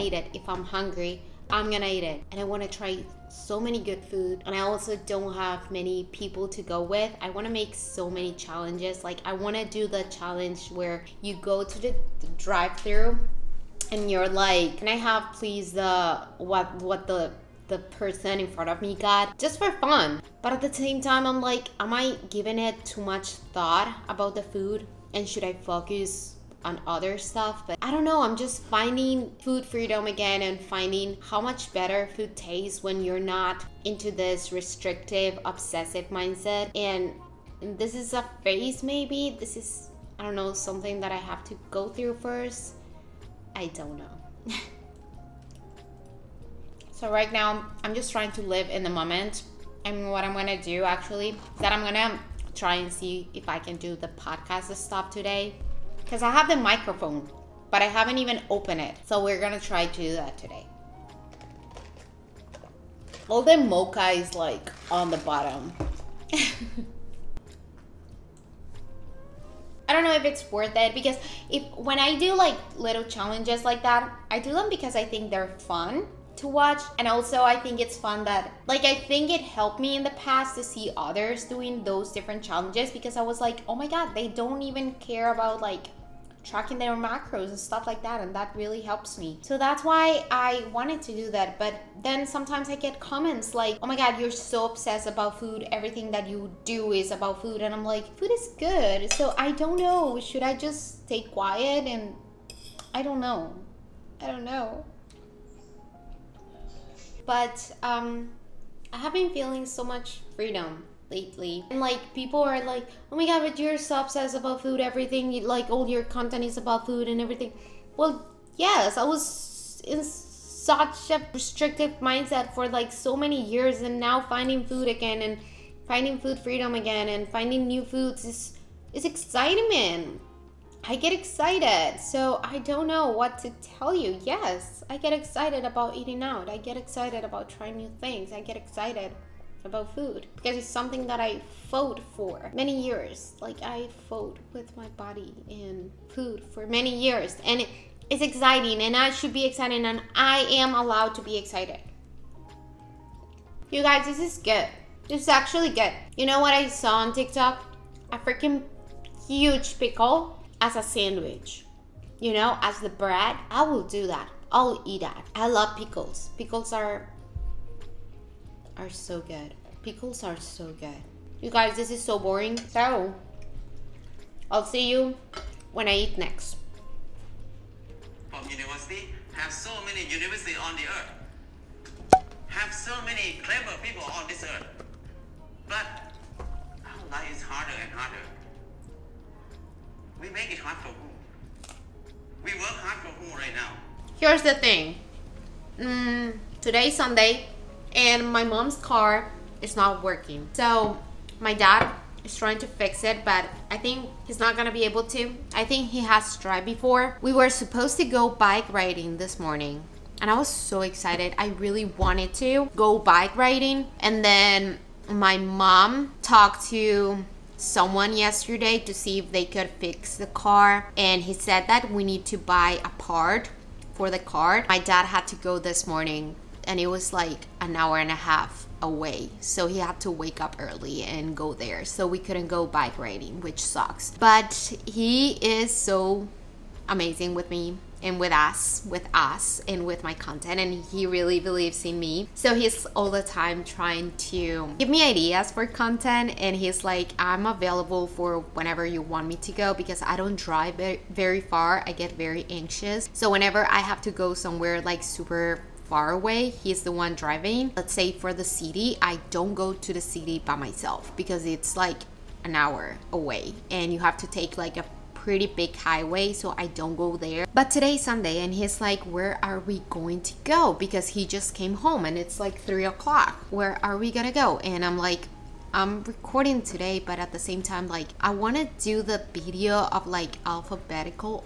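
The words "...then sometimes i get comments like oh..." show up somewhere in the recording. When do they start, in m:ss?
1:32.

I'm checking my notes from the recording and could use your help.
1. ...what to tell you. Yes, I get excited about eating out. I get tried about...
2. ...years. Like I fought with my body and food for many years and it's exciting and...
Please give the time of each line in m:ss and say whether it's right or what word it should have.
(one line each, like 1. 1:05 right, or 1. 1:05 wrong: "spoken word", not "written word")
1. 2:13 wrong: "excited", not "tried"
2. 2:22 right.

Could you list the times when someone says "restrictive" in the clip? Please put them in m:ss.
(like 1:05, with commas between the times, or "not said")
0:34, 2:01.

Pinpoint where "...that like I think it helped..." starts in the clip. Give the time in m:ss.
1:18.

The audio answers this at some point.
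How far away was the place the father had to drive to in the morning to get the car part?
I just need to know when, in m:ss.
3:47.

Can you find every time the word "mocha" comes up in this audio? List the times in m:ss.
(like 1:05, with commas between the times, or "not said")
1:03.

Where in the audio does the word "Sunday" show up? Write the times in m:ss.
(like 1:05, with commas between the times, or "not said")
3:16, 4:28.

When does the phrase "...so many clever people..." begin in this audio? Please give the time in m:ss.
3:02.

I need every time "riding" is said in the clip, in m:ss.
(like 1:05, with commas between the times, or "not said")
3:28, 3:33, 3:52.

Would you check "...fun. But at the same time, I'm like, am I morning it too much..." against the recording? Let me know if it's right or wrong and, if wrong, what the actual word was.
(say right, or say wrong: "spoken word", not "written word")
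wrong: "giving", not "morning".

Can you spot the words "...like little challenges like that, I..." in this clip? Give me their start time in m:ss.
1:12.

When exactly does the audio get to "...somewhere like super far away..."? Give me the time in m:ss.
4:14.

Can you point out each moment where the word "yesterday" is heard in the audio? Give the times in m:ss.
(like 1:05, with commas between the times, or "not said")
3:38.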